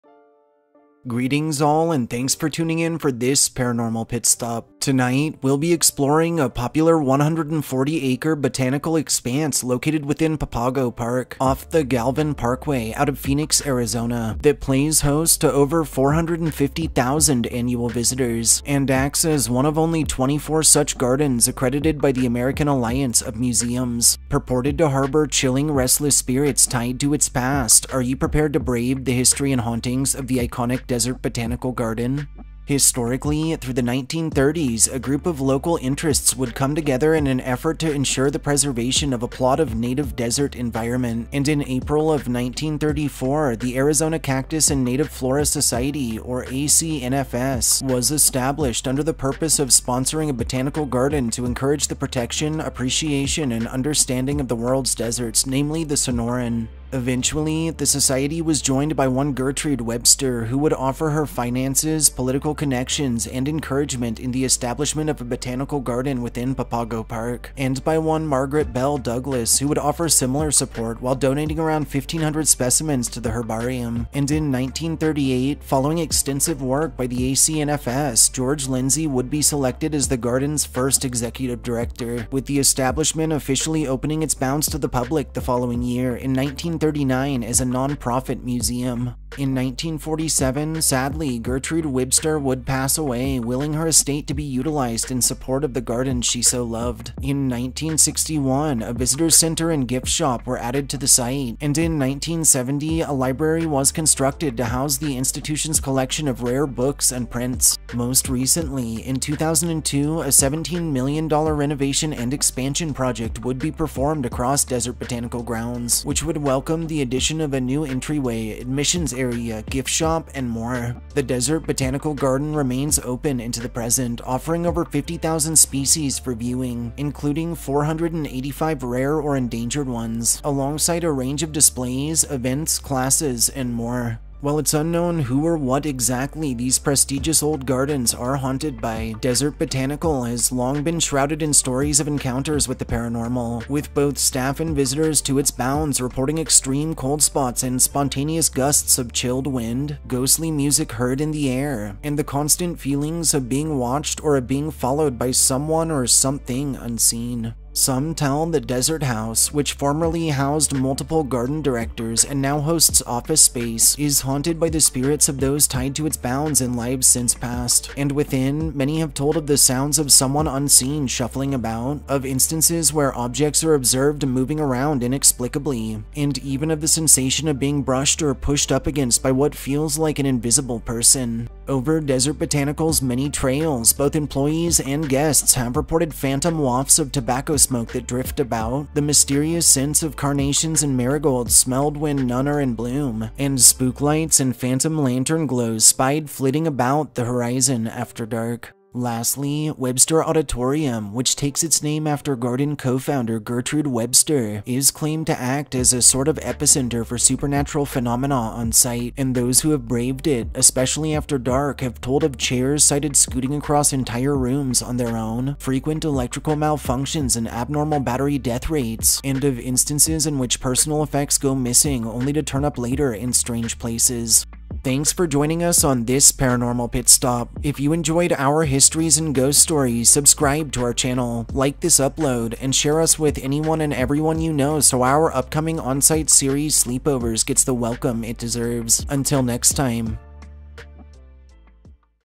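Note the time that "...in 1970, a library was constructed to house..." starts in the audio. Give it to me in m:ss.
1:41.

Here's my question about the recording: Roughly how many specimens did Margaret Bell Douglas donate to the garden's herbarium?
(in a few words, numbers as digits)
1,500.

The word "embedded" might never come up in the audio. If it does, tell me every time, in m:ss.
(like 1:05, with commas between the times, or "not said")
not said.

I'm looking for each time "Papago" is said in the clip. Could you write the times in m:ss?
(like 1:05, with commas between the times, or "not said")
0:10, 1:06.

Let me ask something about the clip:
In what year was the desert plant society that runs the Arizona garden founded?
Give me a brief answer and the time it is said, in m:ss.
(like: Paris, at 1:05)
1934, at 0:42.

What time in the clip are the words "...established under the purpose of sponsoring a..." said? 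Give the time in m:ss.
0:48.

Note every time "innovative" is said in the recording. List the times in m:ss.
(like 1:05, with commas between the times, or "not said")
not said.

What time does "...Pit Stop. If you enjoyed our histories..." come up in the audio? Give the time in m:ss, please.
3:46.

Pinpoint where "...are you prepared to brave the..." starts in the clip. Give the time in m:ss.
0:27.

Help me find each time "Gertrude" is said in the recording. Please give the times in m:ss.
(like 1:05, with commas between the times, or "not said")
0:59, 1:31, 3:23.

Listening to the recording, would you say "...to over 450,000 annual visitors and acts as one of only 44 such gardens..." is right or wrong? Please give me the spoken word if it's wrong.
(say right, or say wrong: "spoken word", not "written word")
wrong: "24", not "44".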